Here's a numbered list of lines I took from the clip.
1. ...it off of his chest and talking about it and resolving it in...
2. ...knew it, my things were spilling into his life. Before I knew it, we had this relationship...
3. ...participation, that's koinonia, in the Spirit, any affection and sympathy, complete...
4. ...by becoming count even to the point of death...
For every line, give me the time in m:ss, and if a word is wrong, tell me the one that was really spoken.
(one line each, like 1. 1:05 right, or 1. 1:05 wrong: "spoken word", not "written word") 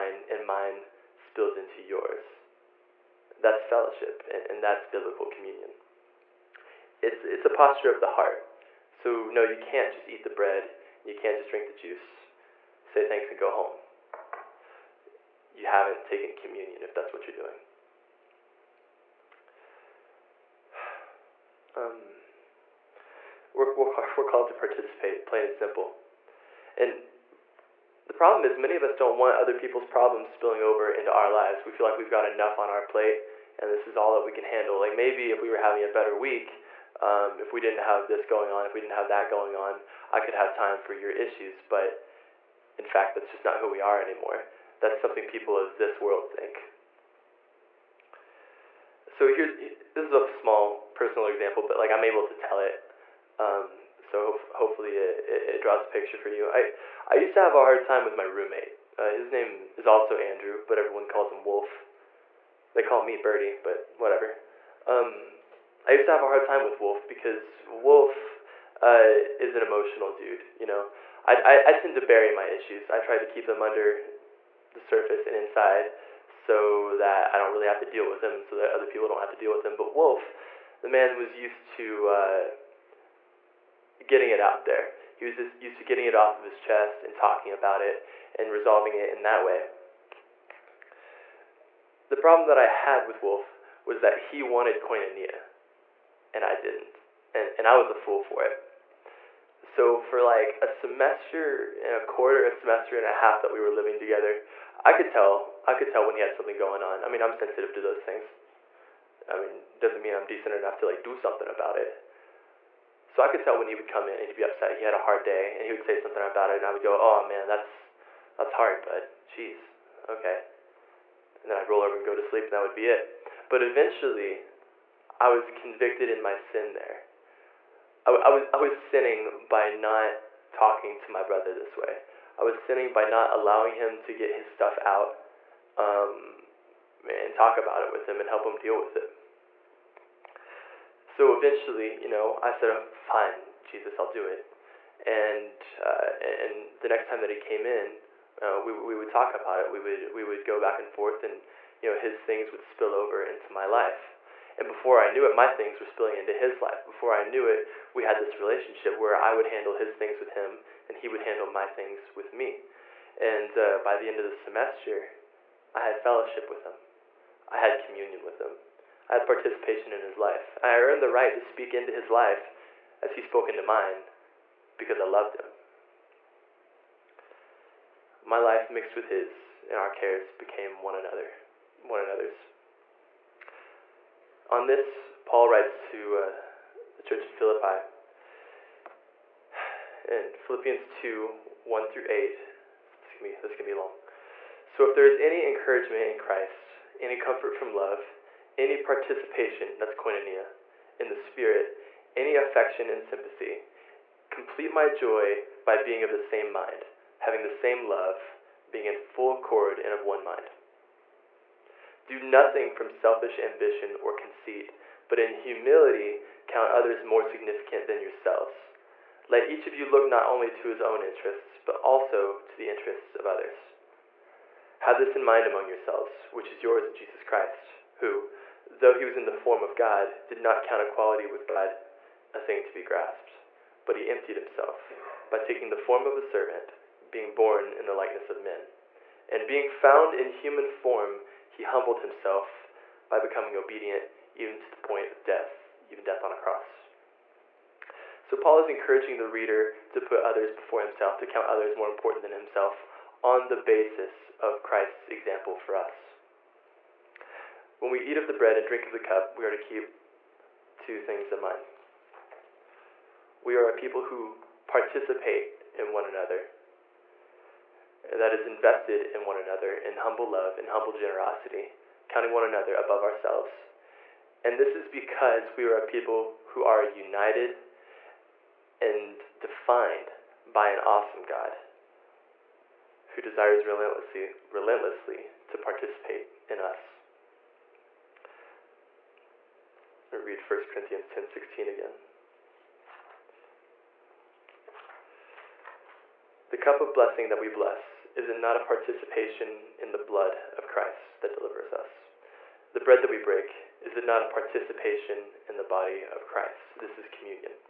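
1. 1:26 right
2. 2:35 right
3. 3:18 right
4. 4:03 wrong: "obedient", not "count".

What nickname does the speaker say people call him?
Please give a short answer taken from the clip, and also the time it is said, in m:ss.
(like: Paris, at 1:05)
Birdie, at 1:03.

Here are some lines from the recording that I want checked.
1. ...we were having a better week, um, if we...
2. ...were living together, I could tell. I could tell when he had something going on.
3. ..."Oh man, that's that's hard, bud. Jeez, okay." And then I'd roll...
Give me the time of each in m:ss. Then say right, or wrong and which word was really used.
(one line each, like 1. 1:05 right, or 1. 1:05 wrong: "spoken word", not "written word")
1. 0:35 right
2. 1:43 right
3. 1:56 right.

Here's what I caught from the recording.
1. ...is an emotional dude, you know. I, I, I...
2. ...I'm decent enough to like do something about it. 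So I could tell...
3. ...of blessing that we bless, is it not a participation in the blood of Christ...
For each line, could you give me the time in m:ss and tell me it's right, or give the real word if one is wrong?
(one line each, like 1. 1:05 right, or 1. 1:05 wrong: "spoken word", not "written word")
1. 1:09 right
2. 1:50 right
3. 4:56 right.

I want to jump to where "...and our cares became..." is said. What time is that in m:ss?
2:59.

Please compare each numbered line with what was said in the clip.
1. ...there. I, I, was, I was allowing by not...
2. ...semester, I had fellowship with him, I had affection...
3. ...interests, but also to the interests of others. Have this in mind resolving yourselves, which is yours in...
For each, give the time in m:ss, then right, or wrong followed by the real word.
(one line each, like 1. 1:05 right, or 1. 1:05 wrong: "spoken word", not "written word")
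1. 2:06 wrong: "sinning", not "allowing"
2. 2:44 wrong: "communion", not "affection"
3. 3:41 wrong: "among", not "resolving".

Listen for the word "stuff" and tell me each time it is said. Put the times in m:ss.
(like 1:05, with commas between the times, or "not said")
2:14.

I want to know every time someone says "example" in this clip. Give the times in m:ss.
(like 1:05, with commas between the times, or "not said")
0:51, 4:15.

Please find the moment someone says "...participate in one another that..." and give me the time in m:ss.
4:24.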